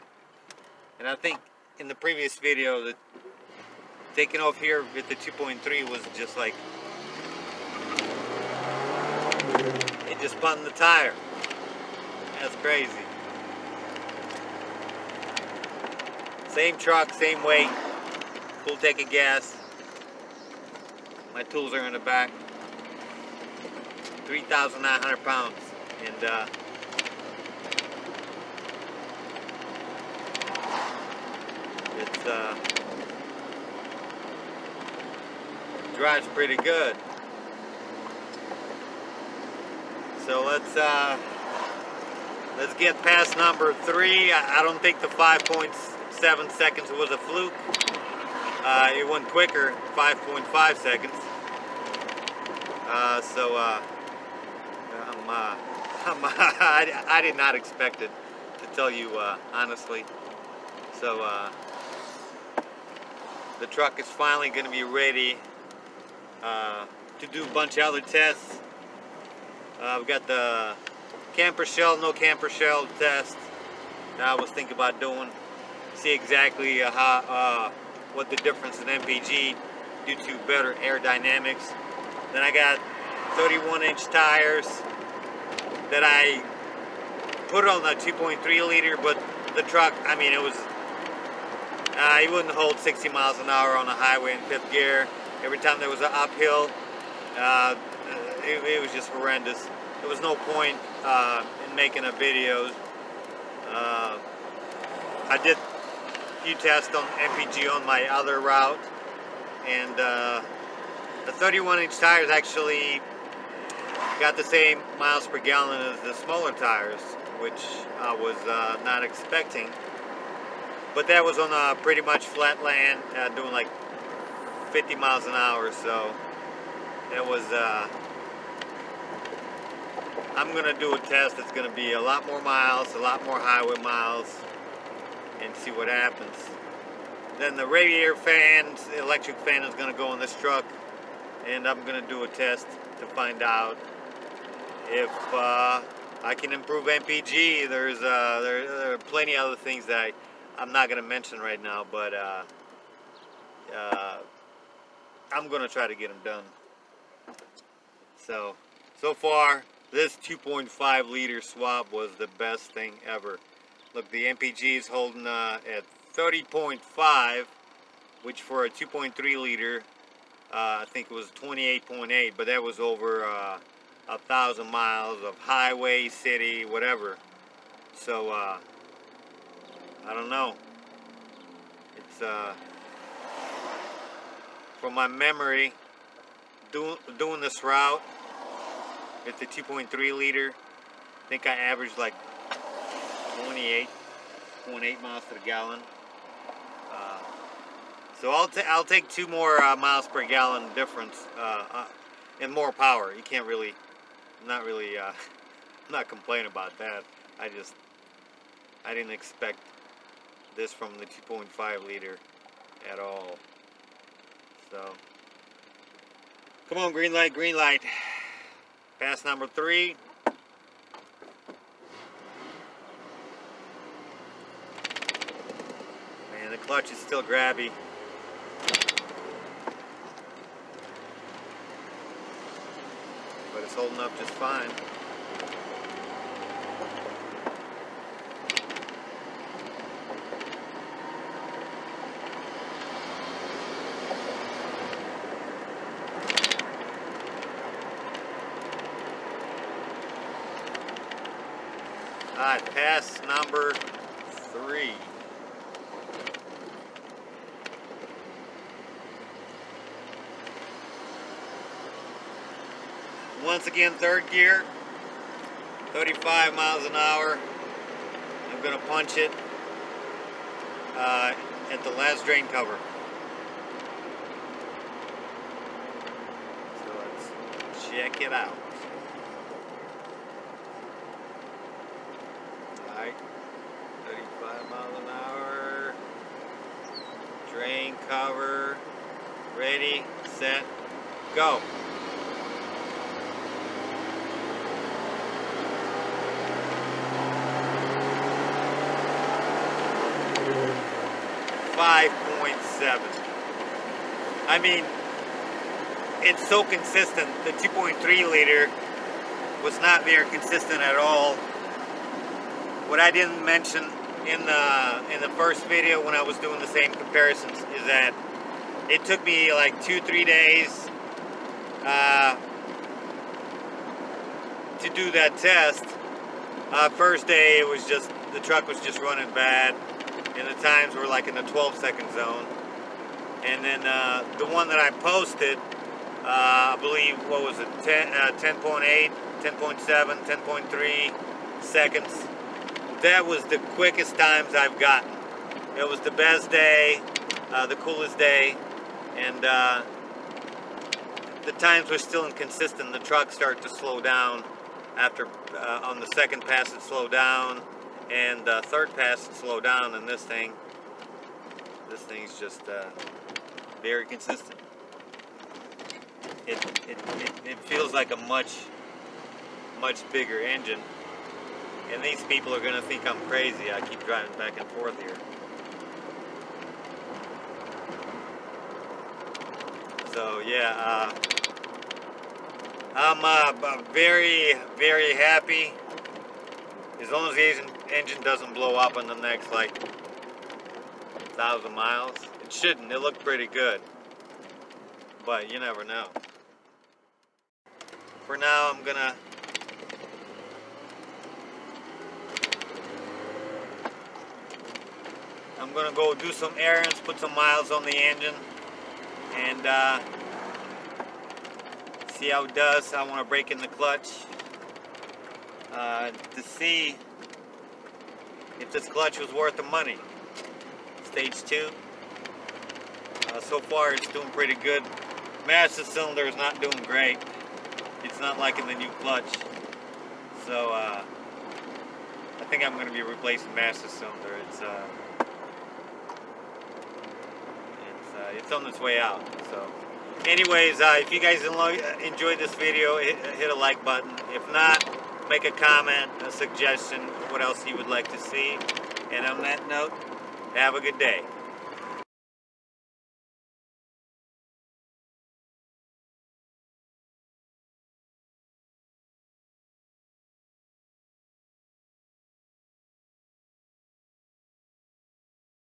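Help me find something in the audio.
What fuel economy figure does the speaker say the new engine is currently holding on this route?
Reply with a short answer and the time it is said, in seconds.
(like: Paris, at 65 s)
30.5 mpg, at 166 s.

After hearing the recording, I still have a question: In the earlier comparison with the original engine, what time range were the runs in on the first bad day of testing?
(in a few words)
12 seconds.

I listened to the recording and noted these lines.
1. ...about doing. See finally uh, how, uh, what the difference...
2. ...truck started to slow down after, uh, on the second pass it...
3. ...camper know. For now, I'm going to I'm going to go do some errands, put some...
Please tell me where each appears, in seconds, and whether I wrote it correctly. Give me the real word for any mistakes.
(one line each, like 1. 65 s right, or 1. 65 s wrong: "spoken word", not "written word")
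1. 74 s wrong: "exactly", not "finally"
2. 352 s right
3. 395 s wrong: "never", not "camper".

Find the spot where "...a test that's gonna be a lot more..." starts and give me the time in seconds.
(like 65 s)
130 s.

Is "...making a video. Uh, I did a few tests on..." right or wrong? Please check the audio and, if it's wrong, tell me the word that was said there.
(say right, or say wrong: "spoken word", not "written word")
right.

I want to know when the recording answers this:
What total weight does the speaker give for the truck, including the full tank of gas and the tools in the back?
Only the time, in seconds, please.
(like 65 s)
24 s.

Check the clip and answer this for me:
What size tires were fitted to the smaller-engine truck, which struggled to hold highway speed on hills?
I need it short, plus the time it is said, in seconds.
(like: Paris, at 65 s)
31 inch, at 83 s.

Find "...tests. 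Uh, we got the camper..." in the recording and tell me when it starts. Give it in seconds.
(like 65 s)
68 s.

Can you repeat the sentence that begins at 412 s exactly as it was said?
I want to break in the clutch uh, to see if this clutch was worth the money.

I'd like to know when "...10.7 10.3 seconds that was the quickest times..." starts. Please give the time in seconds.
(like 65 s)
339 s.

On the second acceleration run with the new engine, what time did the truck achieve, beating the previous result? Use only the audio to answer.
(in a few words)
5.5 seconds.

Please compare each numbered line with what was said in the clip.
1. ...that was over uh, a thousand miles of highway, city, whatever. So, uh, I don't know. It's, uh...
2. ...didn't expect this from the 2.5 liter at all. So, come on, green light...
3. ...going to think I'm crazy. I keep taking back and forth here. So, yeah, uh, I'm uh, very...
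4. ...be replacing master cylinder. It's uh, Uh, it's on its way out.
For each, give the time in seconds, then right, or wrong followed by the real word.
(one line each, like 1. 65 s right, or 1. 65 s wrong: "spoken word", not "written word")
1. 172 s right
2. 208 s right
3. 372 s wrong: "driving", not "taking"
4. 432 s right.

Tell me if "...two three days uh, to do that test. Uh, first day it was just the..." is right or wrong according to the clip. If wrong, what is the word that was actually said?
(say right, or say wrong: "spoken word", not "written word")
right.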